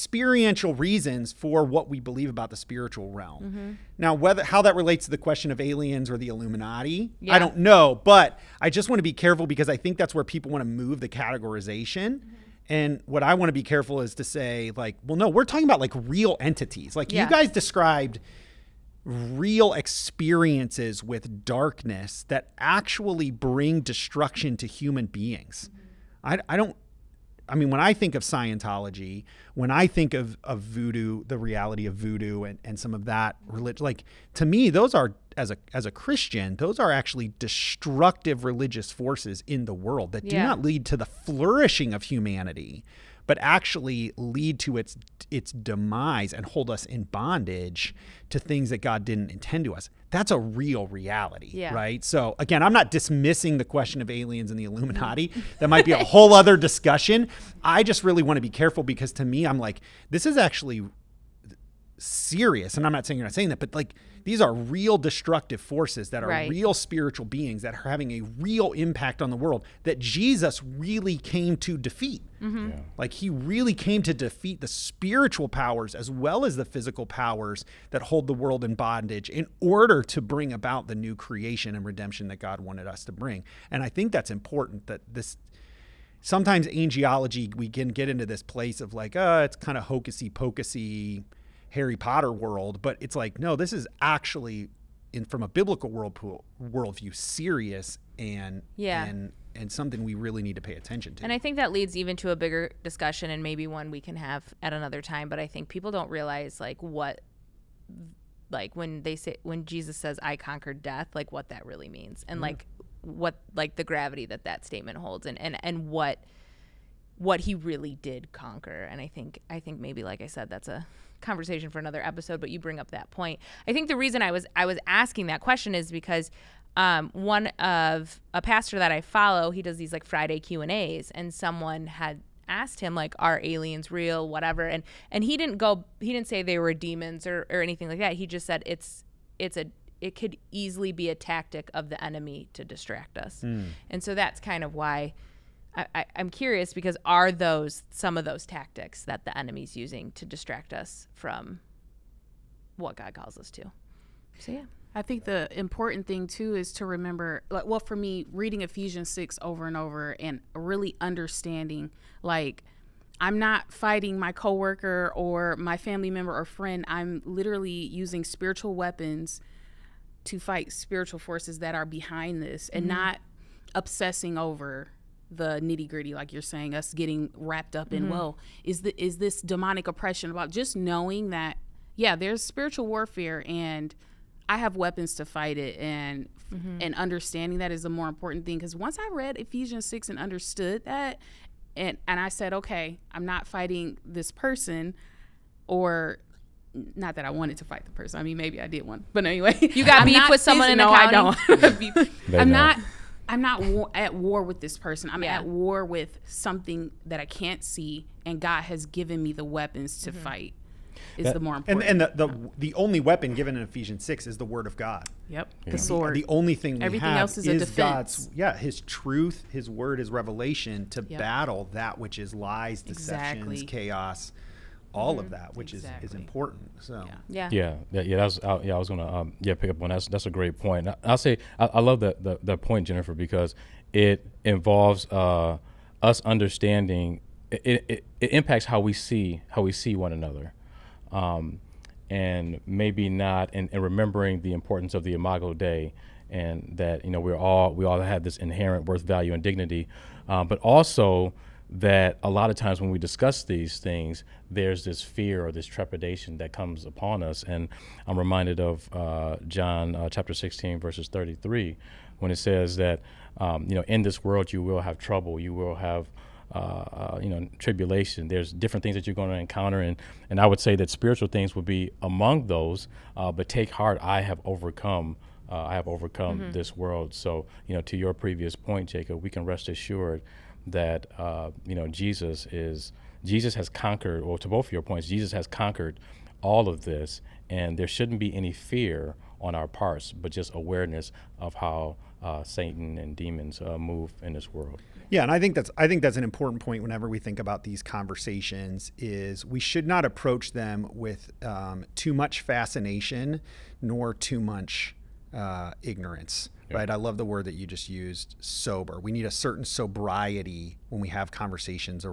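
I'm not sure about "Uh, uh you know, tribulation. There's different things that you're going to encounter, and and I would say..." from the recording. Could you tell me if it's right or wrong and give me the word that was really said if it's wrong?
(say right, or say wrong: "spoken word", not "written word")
right.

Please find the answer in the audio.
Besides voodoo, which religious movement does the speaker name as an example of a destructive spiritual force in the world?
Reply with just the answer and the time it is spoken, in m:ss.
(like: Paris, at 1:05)
Scientology, at 0:28.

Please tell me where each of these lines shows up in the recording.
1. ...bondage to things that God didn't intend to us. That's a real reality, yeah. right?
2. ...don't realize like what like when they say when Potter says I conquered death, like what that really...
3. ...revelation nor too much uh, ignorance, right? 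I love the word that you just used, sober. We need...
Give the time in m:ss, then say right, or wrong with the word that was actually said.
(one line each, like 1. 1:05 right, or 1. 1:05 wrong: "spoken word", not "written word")
1. 0:47 right
2. 1:45 wrong: "Jesus", not "Potter"
3. 5:02 wrong: "fascination", not "revelation".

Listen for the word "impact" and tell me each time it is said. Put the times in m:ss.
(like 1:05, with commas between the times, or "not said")
1:08, 3:58.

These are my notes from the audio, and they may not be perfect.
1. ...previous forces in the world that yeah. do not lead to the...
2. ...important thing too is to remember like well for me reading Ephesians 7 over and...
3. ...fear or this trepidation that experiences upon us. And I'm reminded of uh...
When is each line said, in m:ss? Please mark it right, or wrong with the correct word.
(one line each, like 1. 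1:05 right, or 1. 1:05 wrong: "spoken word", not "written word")
1. 0:38 wrong: "religious", not "previous"
2. 2:35 wrong: "6", not "7"
3. 4:15 wrong: "comes", not "experiences".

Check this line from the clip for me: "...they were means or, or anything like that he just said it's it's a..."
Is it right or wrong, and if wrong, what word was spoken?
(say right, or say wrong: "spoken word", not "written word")
wrong: "demons", not "means".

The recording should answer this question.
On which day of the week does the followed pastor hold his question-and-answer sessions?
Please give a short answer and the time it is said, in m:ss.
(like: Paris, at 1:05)
Friday, at 2:10.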